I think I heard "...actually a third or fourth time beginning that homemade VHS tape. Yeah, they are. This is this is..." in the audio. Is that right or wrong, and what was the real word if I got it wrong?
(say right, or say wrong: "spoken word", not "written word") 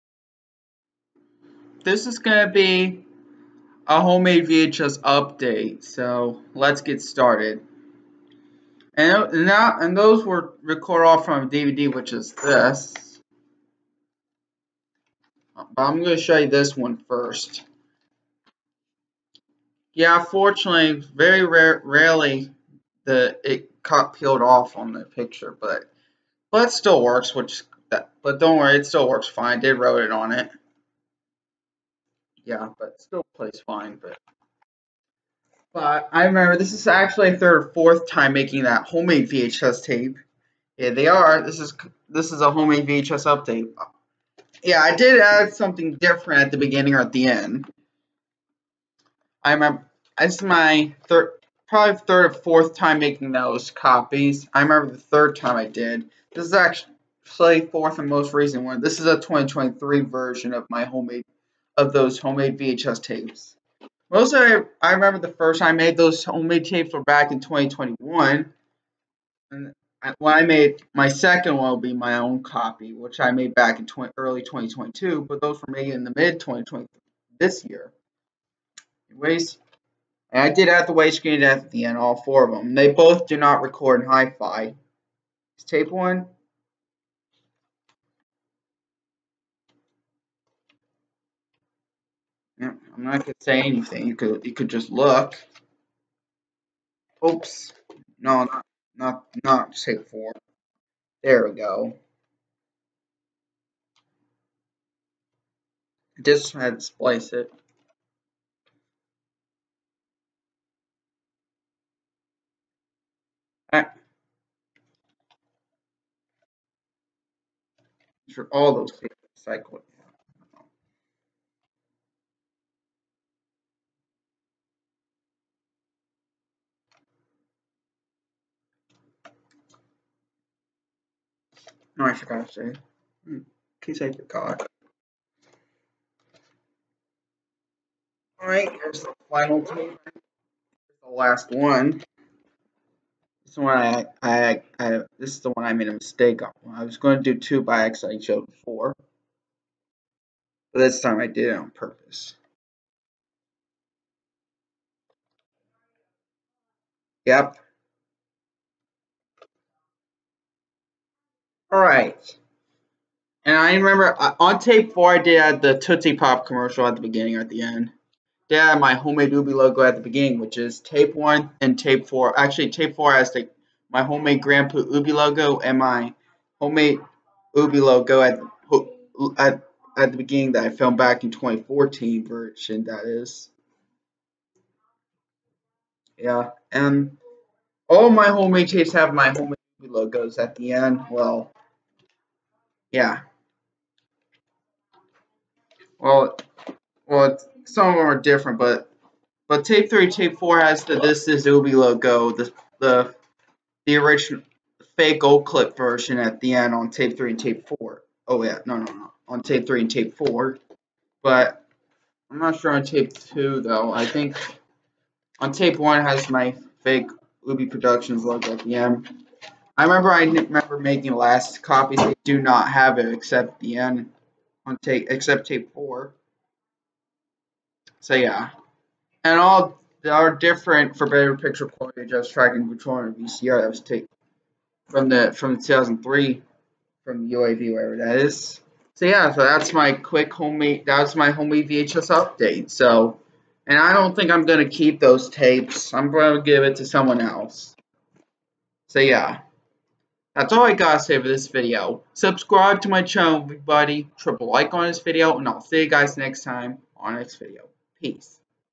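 wrong: "making", not "beginning".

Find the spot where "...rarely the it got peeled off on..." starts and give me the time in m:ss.
0:21.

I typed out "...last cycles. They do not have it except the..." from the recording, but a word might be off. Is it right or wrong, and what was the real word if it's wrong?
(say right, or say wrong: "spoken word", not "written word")
wrong: "copies", not "cycles".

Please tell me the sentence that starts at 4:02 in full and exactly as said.
So and I don't think I'm gonna keep those tapes.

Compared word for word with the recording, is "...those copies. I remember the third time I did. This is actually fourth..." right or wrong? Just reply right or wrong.
right.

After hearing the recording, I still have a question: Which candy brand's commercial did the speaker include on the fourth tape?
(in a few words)
Tootsie Pop.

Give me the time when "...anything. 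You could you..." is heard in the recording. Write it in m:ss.
1:33.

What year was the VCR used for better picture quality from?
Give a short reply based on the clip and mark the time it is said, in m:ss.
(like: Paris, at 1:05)
2003, at 3:55.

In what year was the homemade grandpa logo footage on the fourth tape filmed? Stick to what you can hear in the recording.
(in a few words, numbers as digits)
2014.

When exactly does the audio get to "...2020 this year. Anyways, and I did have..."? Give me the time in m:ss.
1:16.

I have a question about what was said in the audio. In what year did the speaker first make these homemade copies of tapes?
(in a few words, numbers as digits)
2021.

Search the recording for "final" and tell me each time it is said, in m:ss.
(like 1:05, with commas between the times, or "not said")
2:19.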